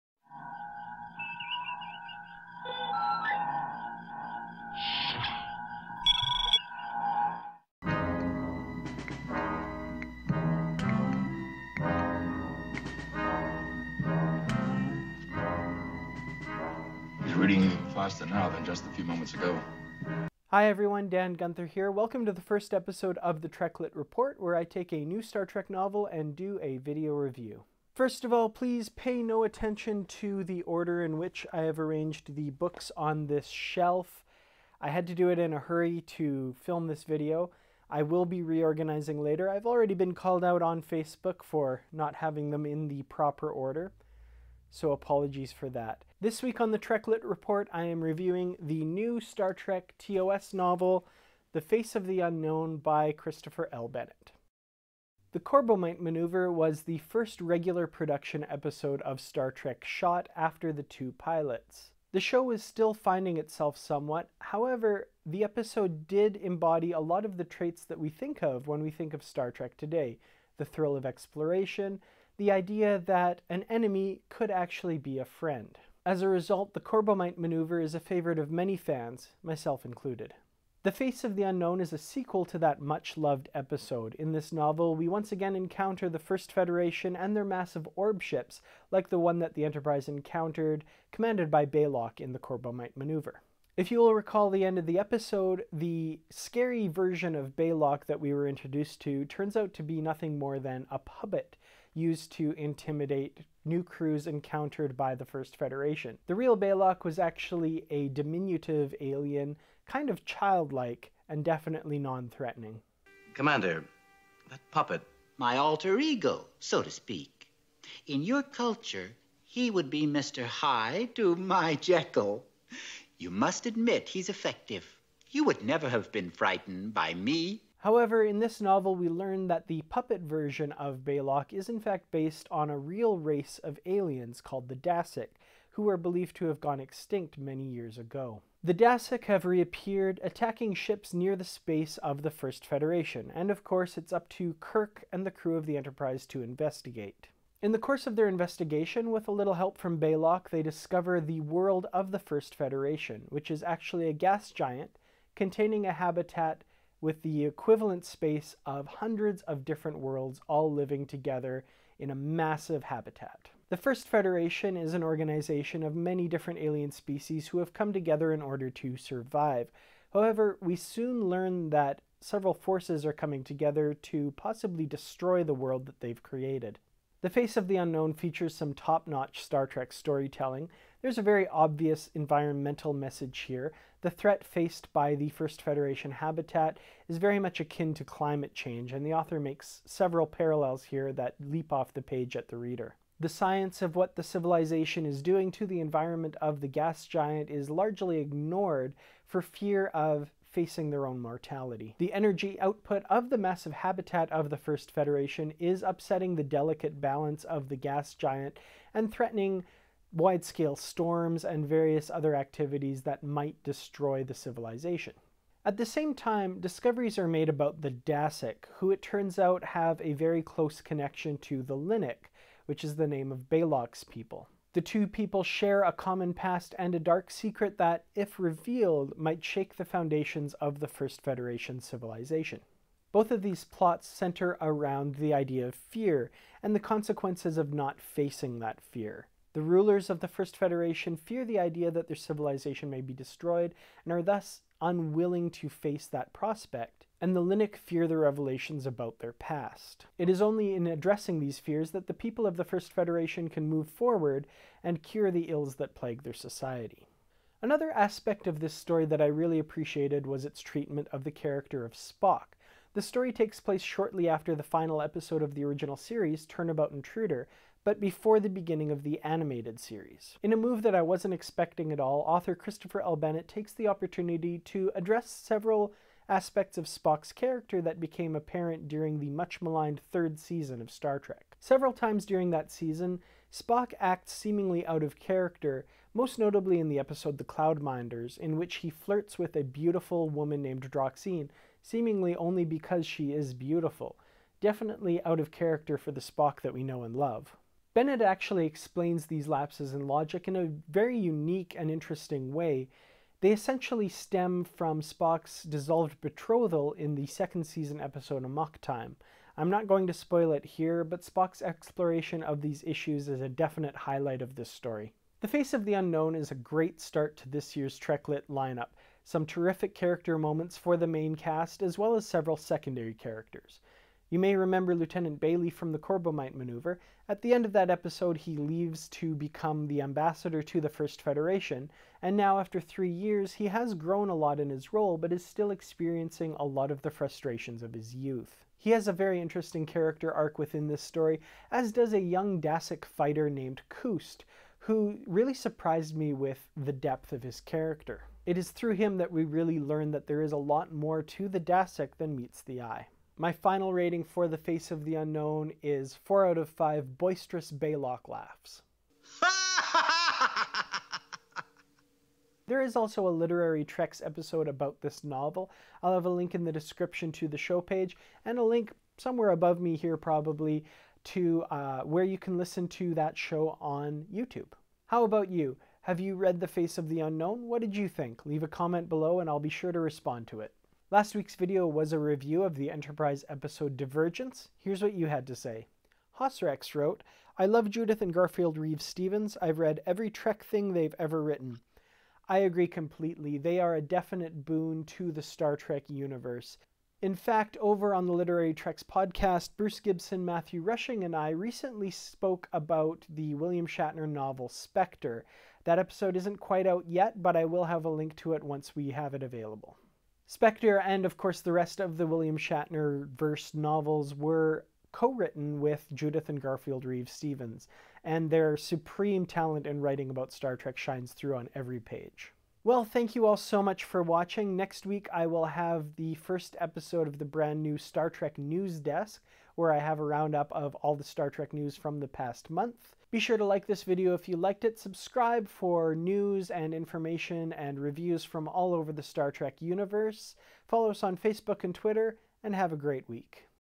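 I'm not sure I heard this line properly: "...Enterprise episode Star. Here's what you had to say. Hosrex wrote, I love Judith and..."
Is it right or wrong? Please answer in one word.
wrong.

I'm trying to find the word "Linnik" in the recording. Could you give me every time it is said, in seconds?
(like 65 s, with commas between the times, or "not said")
221 s, 247 s.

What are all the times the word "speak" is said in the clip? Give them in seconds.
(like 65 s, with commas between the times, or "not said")
116 s.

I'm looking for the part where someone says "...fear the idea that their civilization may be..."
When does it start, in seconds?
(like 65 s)
241 s.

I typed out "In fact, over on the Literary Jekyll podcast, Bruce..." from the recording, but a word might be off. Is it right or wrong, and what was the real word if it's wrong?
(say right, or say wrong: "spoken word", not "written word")
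wrong: "Treks", not "Jekyll".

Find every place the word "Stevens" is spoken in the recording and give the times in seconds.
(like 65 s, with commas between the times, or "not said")
389 s, 417 s.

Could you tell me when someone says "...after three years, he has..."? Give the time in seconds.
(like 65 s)
332 s.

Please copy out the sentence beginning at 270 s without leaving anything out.
In a move that I wasn't expecting at all, author Christopher L.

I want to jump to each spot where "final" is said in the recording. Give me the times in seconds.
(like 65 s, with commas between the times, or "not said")
264 s, 353 s.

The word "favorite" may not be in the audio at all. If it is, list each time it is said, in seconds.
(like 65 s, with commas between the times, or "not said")
77 s.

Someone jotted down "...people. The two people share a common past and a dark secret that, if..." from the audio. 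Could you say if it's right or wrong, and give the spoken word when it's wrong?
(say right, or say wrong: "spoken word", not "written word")
right.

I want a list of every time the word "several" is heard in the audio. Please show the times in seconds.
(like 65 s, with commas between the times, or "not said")
172 s, 189 s, 275 s, 281 s, 322 s.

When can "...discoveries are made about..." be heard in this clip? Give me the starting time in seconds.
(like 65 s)
216 s.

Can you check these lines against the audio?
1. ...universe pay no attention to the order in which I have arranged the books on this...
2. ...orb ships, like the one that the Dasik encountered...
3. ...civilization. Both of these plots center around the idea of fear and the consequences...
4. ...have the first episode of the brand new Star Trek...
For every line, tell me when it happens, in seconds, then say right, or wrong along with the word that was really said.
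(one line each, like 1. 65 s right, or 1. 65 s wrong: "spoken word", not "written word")
1. 28 s wrong: "please", not "universe"
2. 87 s wrong: "Enterprise", not "Dasik"
3. 231 s right
4. 425 s right.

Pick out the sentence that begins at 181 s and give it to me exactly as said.
There's a very obvious environmental message here.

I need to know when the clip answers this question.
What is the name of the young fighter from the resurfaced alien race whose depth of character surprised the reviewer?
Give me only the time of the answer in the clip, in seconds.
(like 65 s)
343 s.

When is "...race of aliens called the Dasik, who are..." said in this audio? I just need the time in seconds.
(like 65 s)
133 s.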